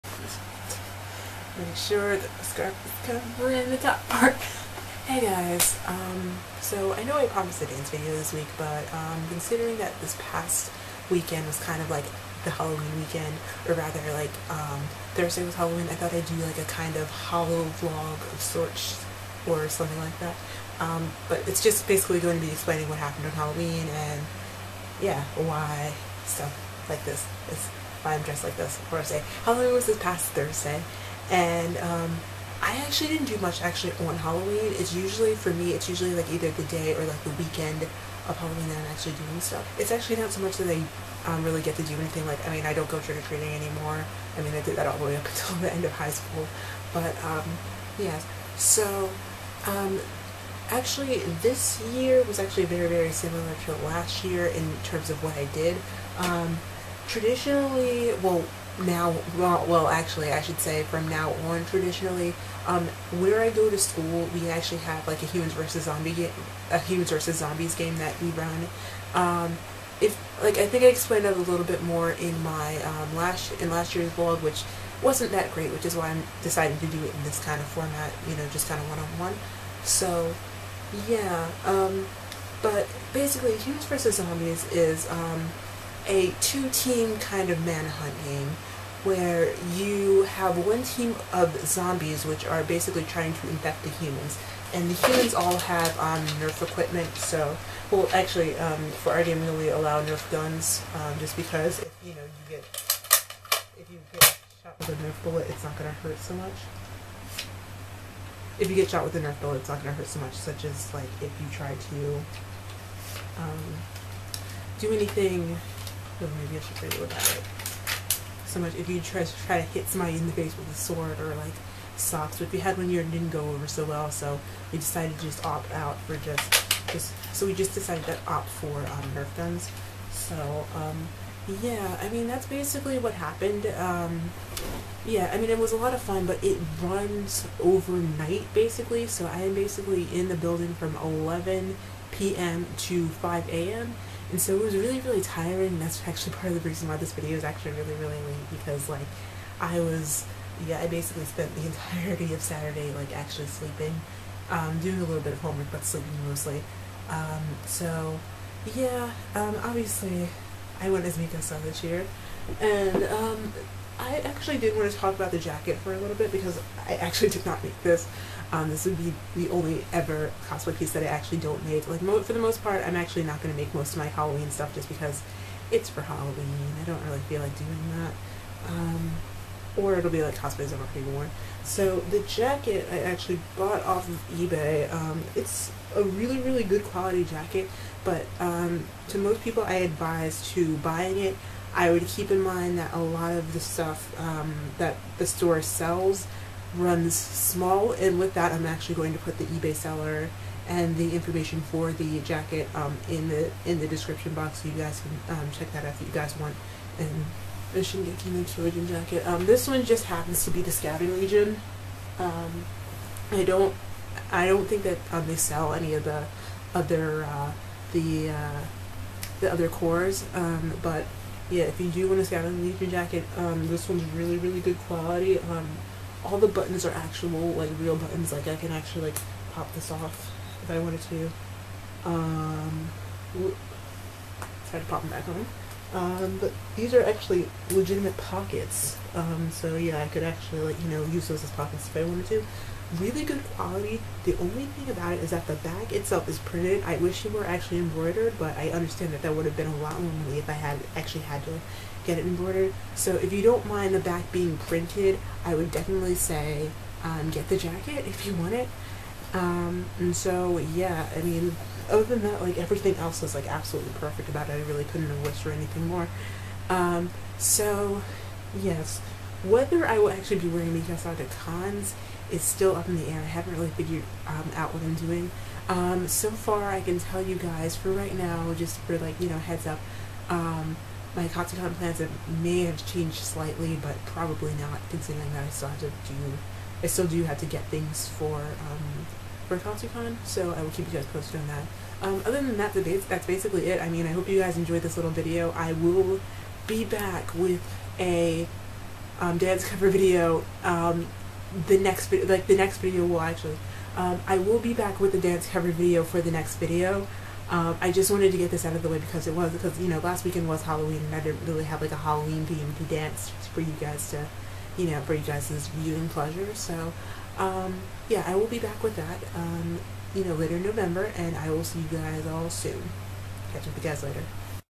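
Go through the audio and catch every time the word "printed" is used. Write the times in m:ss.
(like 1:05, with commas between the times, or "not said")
4:06, 4:14.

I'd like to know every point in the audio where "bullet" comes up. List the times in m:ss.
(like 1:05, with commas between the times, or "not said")
1:45, 1:49.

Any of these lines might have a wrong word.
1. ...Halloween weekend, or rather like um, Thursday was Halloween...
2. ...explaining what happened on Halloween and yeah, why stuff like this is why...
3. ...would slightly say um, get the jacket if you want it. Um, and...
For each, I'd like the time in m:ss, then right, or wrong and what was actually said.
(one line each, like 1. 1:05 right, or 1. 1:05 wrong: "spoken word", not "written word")
1. 0:12 right
2. 0:22 right
3. 4:15 wrong: "definitely", not "slightly".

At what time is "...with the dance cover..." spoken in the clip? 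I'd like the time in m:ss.
5:04.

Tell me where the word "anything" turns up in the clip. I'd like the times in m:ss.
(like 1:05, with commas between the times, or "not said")
0:41, 1:54, 4:25.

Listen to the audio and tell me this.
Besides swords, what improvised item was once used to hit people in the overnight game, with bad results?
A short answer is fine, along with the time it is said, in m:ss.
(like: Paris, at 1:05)
Socks, at 2:01.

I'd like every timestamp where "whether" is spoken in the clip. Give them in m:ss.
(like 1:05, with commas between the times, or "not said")
4:29.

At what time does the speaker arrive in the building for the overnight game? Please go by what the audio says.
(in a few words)
11 p.m.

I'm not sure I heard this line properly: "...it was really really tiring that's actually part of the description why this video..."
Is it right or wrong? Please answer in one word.
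wrong.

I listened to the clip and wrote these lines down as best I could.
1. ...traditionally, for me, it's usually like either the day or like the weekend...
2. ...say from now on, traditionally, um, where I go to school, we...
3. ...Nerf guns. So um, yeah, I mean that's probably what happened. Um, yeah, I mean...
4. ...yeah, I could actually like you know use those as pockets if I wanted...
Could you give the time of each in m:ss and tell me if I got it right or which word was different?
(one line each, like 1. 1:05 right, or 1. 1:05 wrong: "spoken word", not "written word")
1. 0:34 wrong: "usually", not "traditionally"
2. 1:00 right
3. 2:09 wrong: "basically", not "probably"
4. 3:59 right.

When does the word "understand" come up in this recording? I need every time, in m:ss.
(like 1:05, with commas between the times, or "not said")
4:08.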